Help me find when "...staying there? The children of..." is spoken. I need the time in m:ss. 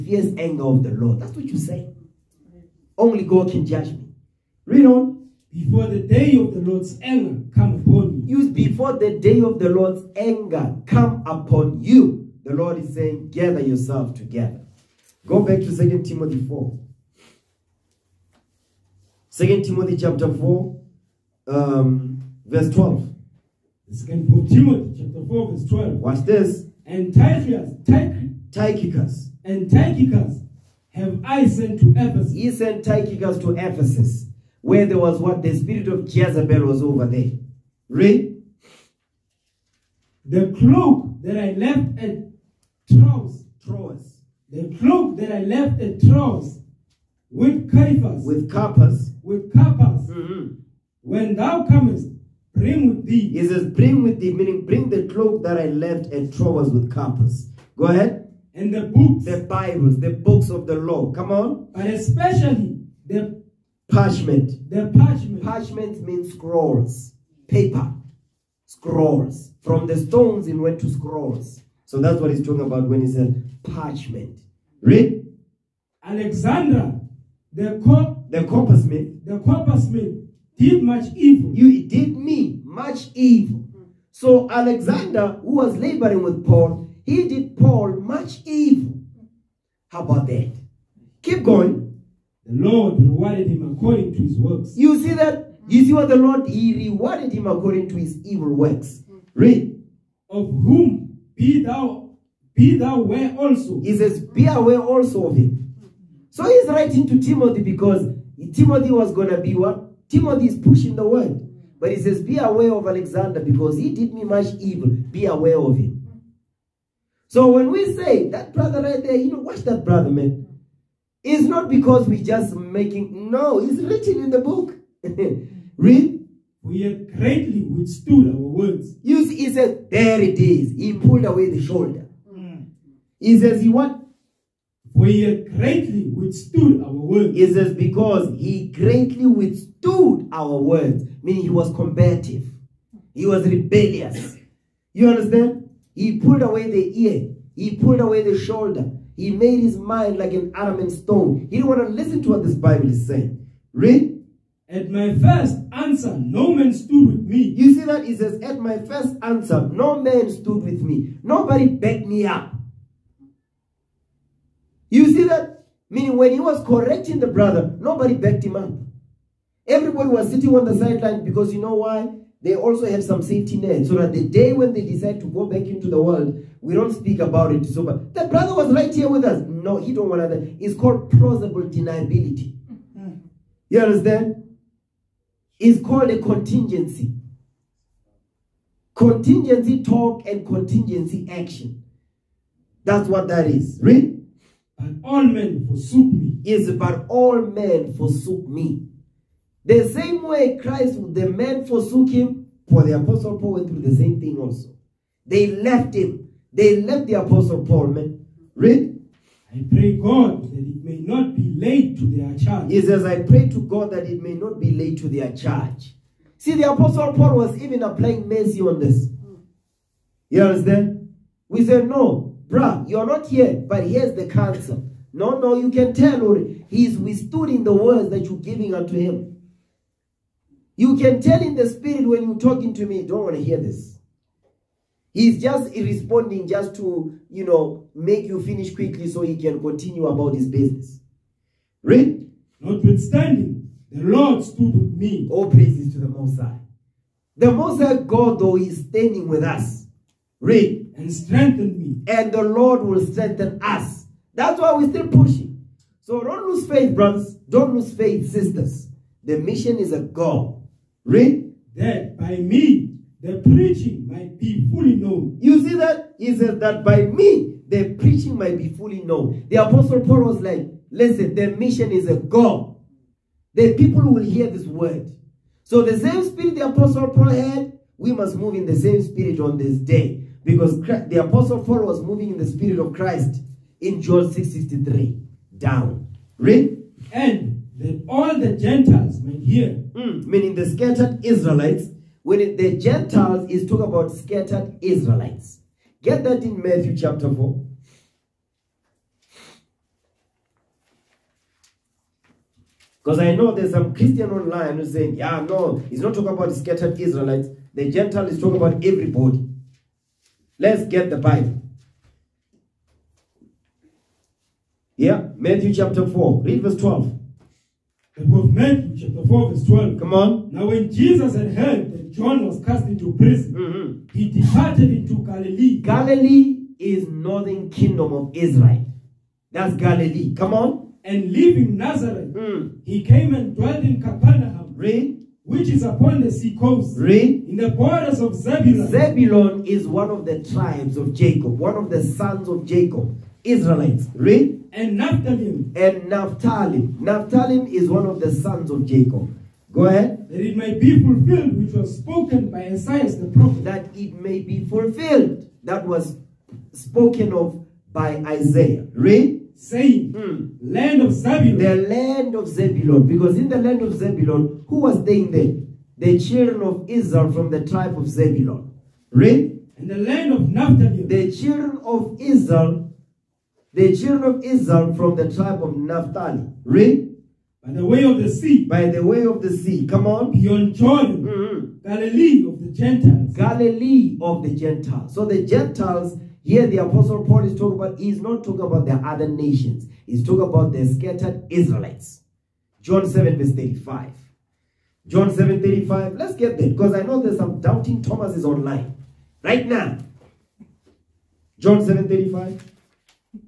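6:05.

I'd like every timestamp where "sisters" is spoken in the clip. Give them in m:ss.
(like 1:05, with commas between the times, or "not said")
4:18.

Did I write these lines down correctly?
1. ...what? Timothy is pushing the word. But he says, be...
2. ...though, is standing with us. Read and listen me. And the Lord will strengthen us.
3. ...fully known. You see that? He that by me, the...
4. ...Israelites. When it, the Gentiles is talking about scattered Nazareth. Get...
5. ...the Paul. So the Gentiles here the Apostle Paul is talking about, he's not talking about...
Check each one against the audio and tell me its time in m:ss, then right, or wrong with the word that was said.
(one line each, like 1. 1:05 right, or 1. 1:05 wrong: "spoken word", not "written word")
1. 1:49 right
2. 4:08 wrong: "strengthen", not "listen"
3. 4:24 right
4. 4:51 wrong: "Israelites", not "Nazareth"
5. 6:24 wrong: "Gentiles", not "Paul".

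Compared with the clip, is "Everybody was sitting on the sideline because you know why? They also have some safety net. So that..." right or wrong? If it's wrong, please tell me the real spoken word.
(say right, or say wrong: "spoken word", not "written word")
right.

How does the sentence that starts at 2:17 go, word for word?
It says, because he greatly withstood our words, meaning he was combative.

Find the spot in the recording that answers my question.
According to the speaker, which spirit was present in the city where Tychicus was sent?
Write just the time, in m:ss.
0:35.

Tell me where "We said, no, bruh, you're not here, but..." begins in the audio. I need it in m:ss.
3:41.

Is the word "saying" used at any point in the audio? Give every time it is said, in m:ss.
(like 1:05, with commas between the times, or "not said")
0:12, 2:33, 5:04, 5:59.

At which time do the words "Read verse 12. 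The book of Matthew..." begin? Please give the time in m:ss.
5:16.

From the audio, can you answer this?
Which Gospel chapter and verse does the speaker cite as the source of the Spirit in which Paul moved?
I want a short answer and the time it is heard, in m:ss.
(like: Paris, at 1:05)
John 6:63, at 4:44.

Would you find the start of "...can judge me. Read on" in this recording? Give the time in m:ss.
0:03.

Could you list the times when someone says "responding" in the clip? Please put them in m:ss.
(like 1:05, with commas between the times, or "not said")
3:55.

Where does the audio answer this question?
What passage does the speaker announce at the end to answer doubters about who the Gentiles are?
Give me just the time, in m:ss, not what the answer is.
6:32.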